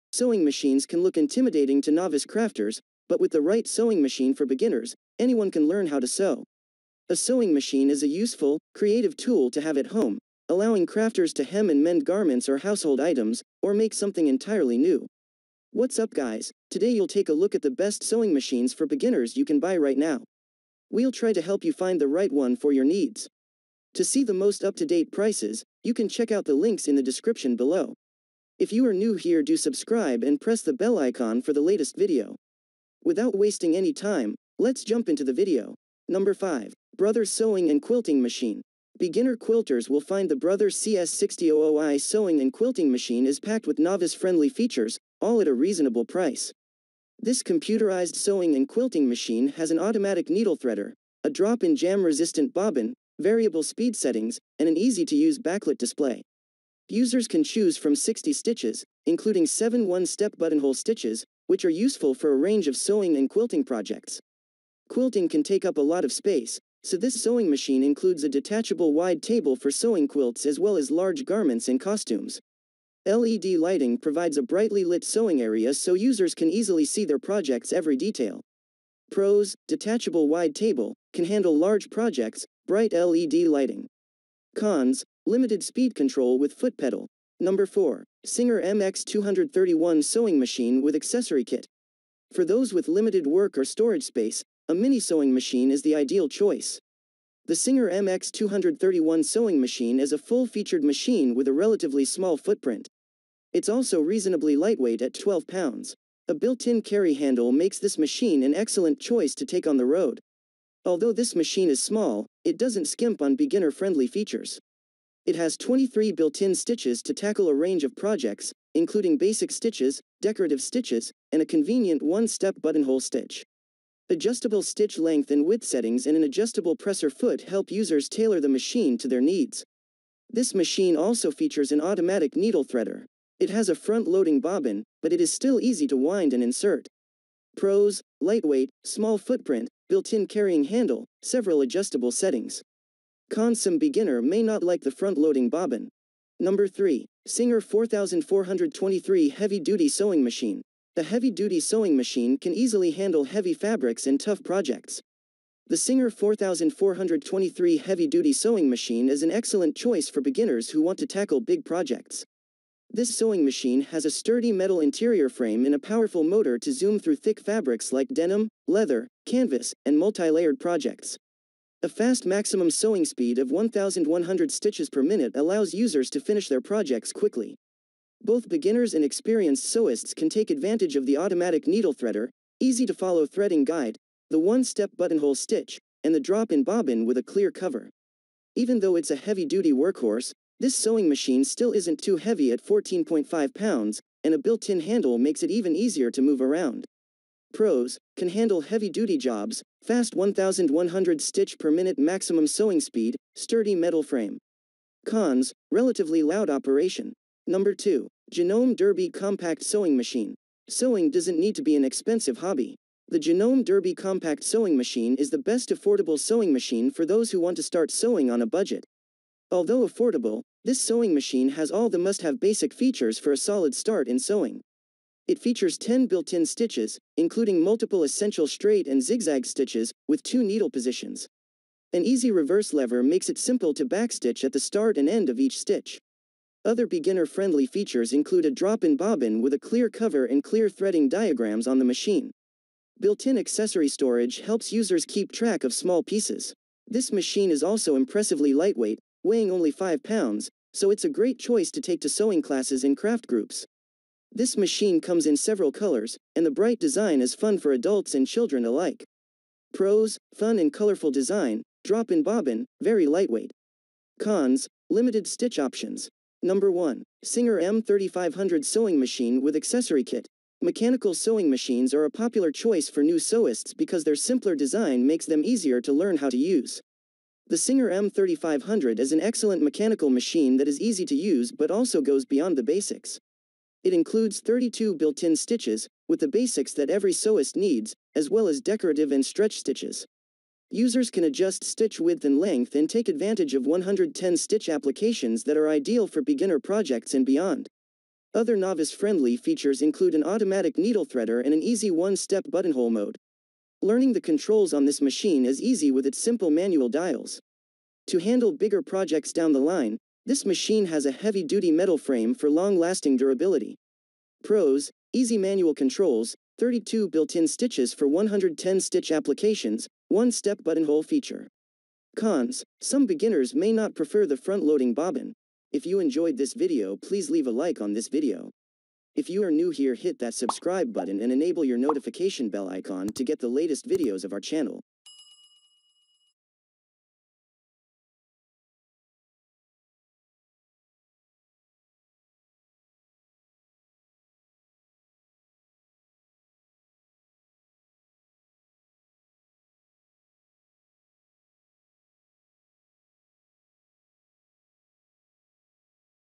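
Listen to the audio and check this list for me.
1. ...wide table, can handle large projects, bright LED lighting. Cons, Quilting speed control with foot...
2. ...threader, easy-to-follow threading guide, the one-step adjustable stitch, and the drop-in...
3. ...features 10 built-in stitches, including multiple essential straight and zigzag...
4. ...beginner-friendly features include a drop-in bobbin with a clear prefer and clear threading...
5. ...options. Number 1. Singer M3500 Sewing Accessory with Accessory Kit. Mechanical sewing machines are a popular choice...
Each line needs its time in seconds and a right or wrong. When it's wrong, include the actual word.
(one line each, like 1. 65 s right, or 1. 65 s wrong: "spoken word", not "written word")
1. 80 s wrong: "Limited", not "Quilting"
2. 181 s wrong: "buttonhole", not "adjustable"
3. 225 s right
4. 236 s wrong: "cover", not "prefer"
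5. 265 s wrong: "Machine", not "Accessory".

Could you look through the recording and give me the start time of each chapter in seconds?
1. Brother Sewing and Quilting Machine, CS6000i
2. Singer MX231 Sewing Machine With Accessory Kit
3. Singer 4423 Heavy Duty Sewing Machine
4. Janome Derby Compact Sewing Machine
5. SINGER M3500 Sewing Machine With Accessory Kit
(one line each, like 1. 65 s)
1. 36 s
2. 88 s
3. 147 s
4. 208 s
5. 267 s.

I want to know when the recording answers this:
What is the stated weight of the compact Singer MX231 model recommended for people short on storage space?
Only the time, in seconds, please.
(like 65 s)
105 s.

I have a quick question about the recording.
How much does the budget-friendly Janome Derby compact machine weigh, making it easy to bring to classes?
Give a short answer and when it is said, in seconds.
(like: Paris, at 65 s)
5 pounds, at 249 s.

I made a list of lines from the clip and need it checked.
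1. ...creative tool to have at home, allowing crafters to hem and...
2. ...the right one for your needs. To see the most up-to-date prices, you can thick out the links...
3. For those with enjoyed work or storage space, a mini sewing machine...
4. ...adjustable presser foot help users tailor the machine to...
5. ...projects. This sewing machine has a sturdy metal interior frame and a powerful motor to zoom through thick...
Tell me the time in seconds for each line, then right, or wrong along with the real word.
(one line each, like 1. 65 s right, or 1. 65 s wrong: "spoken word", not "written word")
1. 8 s right
2. 22 s wrong: "check", not "thick"
3. 92 s wrong: "limited", not "enjoyed"
4. 126 s right
5. 161 s right.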